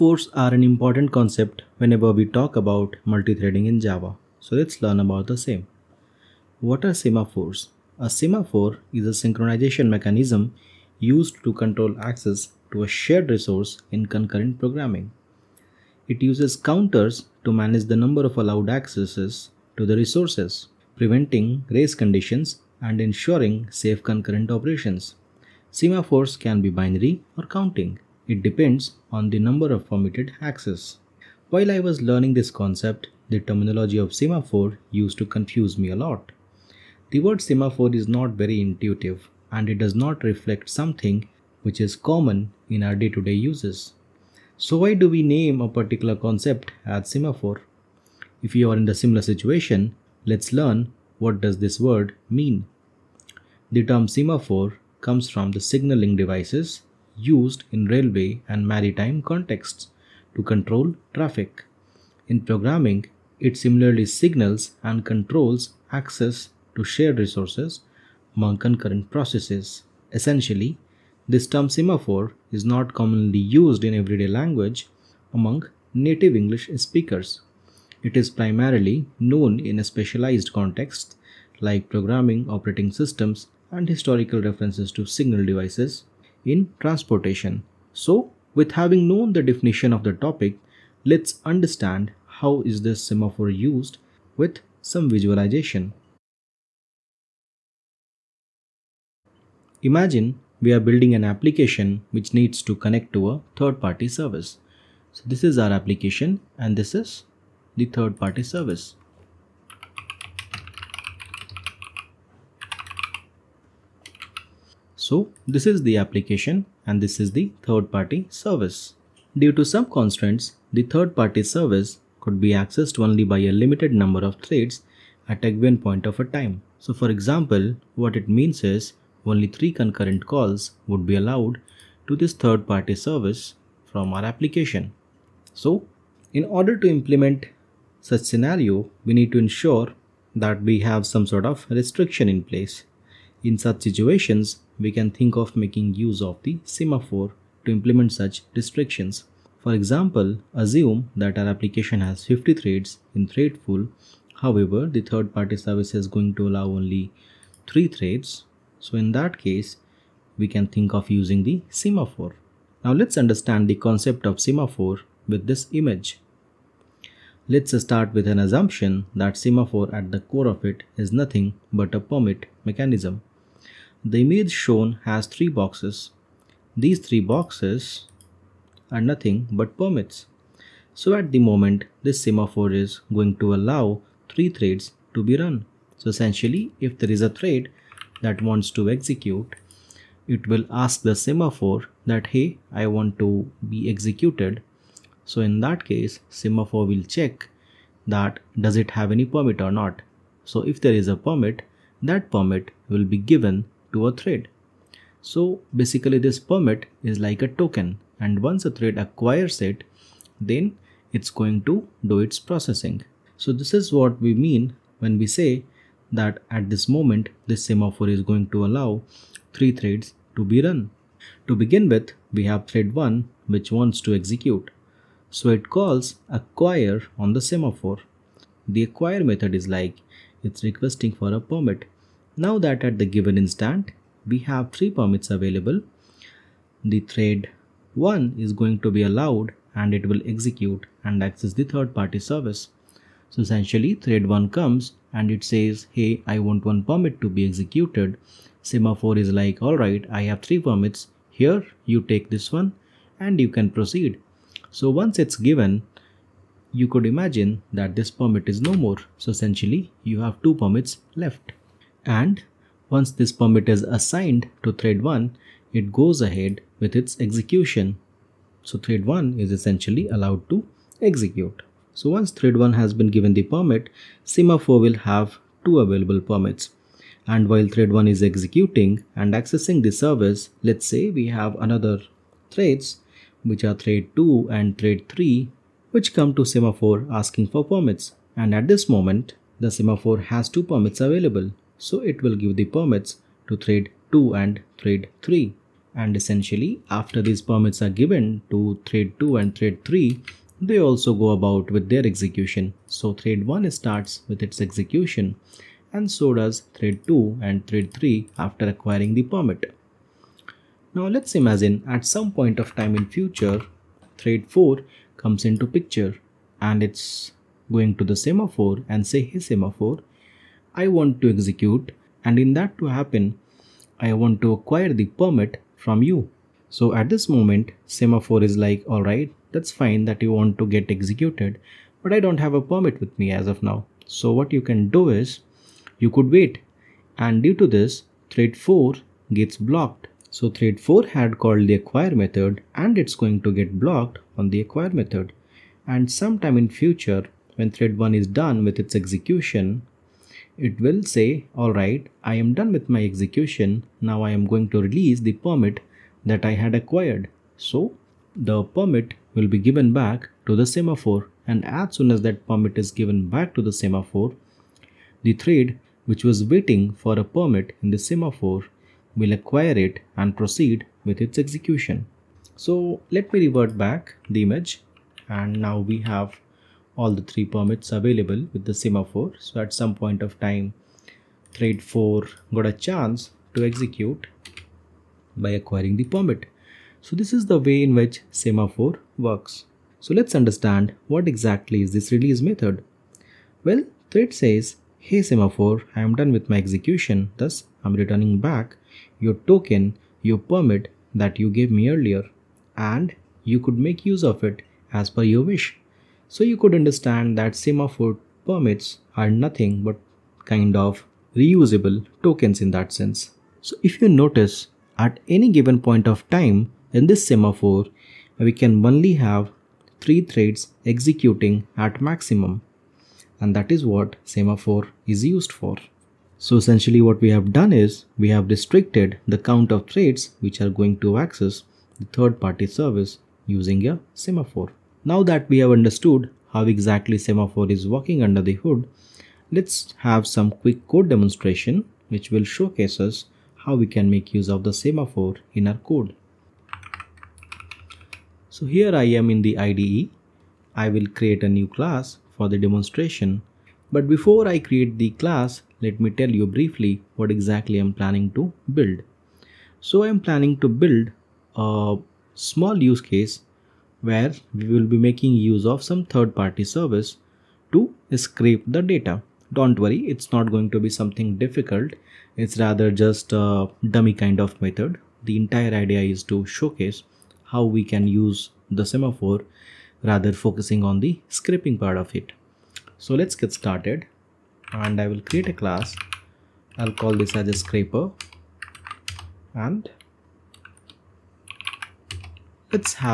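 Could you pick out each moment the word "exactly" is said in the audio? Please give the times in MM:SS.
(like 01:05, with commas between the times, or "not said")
06:31, 07:16, 07:37.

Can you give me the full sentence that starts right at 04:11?
Here, you take this one and you can proceed.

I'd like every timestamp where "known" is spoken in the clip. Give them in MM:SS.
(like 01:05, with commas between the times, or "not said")
01:19, 01:29.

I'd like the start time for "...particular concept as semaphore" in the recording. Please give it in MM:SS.
00:45.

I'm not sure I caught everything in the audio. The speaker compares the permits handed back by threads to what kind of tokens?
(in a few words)
reusable tokens.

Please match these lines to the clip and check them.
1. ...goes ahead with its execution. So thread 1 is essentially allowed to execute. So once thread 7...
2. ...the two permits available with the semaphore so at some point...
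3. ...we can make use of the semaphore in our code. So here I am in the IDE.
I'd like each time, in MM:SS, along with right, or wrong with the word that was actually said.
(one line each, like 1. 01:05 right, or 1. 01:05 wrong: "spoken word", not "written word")
1. 04:25 wrong: "1", not "7"
2. 06:17 wrong: "three", not "two"
3. 07:23 right.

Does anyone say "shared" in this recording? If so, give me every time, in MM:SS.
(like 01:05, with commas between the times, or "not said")
00:12, 01:06.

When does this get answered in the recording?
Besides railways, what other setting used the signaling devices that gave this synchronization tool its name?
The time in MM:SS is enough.
00:58.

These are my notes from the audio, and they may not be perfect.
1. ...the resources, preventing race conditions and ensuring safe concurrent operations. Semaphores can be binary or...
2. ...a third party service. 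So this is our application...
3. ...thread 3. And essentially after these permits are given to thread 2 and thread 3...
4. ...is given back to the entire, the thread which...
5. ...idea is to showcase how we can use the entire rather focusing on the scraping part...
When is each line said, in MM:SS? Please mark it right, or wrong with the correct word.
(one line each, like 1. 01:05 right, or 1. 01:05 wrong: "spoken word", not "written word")
1. 00:19 right
2. 01:43 right
3. 04:54 right
4. 06:02 wrong: "semaphore", not "entire"
5. 07:55 wrong: "semaphore", not "entire".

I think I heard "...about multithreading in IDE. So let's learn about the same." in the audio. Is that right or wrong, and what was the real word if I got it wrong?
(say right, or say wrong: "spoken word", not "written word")
wrong: "Java", not "IDE".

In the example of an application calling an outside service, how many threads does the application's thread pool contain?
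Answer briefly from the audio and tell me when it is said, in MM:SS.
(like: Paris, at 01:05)
50, at 02:32.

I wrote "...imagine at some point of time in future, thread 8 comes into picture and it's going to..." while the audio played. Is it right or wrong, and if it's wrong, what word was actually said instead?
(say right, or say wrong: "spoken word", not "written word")
wrong: "4", not "8".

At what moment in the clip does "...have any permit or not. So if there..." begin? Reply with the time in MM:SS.
03:18.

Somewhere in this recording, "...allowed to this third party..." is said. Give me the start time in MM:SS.
02:11.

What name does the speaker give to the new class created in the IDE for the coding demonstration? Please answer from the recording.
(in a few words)
scraper.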